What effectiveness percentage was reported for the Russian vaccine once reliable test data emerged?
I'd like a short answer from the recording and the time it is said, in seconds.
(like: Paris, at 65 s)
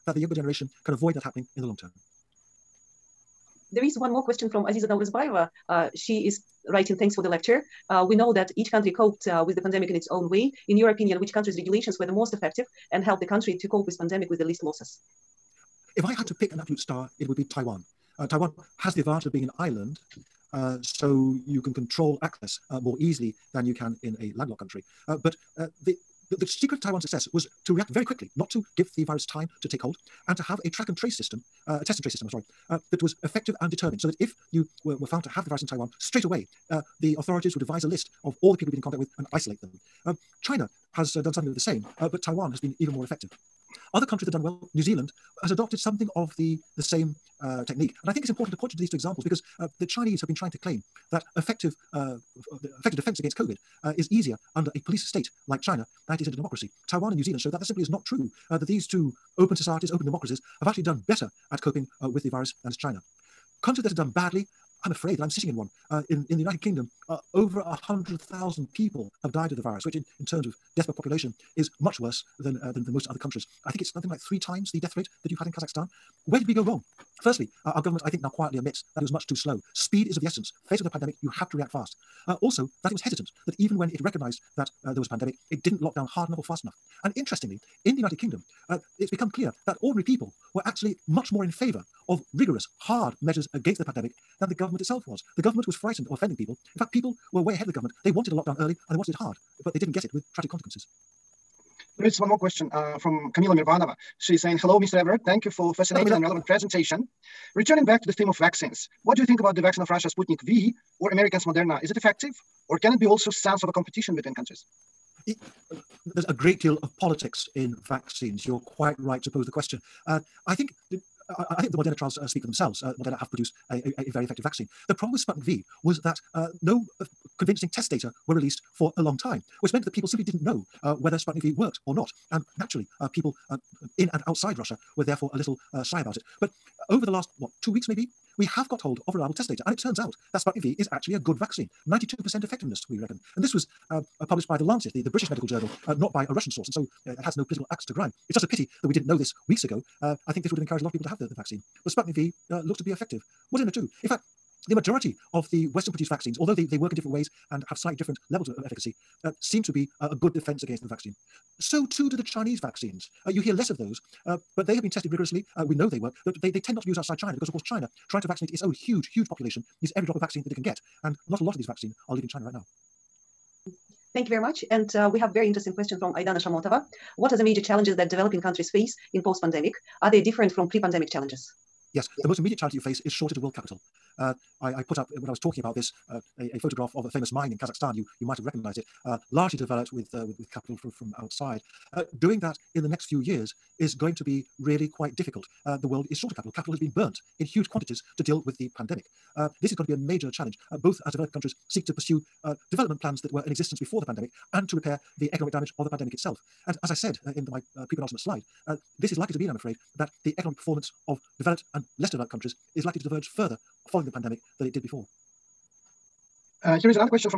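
92%, at 141 s.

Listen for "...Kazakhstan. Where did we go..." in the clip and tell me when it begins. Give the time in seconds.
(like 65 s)
75 s.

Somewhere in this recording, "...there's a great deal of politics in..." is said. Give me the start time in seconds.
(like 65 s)
116 s.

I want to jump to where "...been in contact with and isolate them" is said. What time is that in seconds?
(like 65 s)
38 s.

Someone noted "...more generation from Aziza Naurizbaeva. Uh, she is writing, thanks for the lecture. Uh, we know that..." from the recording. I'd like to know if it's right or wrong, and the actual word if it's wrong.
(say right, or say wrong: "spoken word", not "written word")
wrong: "question", not "generation".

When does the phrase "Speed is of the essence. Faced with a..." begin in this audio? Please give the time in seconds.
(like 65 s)
79 s.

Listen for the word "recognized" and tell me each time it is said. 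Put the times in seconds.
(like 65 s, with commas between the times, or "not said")
84 s, 188 s.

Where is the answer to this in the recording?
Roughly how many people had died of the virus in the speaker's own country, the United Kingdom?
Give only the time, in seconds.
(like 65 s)
67 s.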